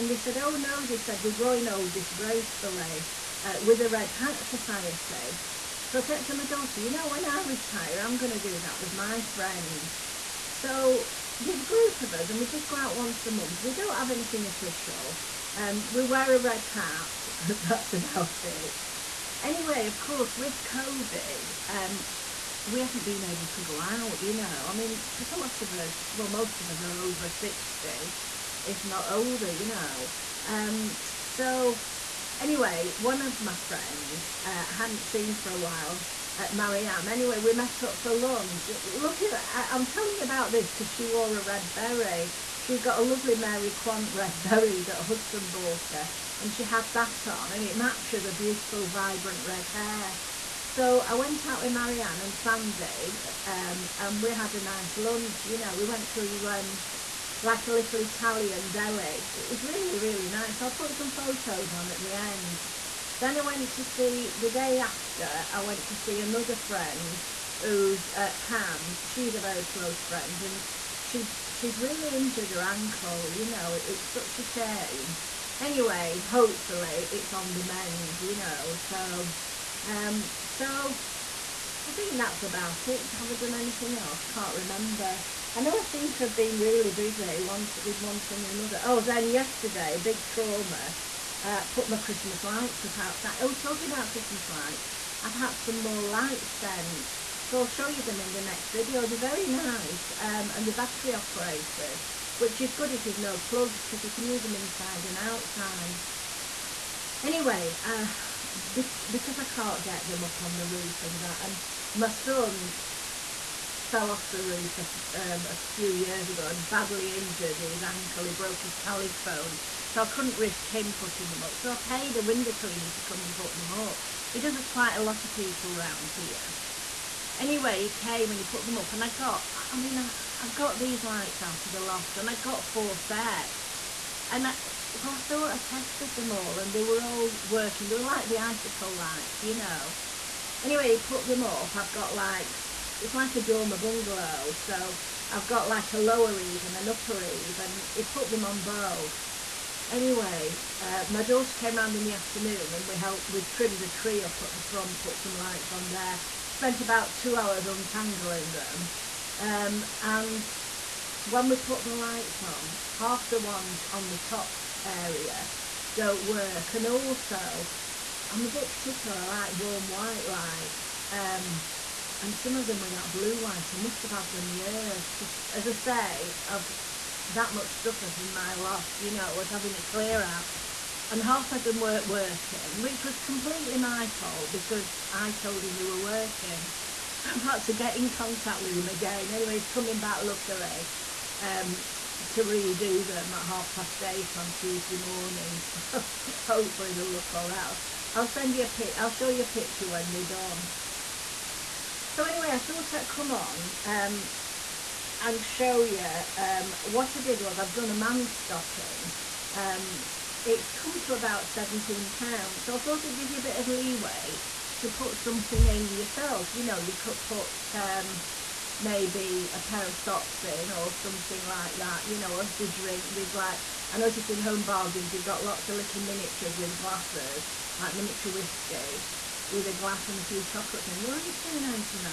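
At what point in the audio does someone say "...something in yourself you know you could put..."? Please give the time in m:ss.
3:35.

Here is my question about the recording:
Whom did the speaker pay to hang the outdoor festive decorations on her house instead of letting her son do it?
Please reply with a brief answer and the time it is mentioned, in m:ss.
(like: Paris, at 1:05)
a window cleaner, at 2:02.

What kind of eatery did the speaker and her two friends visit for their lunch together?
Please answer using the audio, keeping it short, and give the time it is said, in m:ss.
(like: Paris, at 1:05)
Italian deli, at 0:58.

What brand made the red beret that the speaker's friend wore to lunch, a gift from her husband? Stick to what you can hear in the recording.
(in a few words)
Mary Quant.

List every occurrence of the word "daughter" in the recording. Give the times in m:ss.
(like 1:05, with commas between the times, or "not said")
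0:06, 2:31.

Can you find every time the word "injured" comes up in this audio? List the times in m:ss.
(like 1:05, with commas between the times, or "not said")
1:12, 1:57.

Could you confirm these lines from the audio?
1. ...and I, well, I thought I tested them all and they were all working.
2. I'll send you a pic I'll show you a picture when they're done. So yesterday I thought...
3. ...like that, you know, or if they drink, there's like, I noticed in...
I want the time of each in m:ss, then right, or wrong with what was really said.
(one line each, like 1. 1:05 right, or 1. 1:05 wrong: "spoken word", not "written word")
1. 2:14 right
2. 3:18 wrong: "anyway", not "yesterday"
3. 3:41 right.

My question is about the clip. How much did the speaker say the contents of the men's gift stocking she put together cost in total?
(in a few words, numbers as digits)
£17.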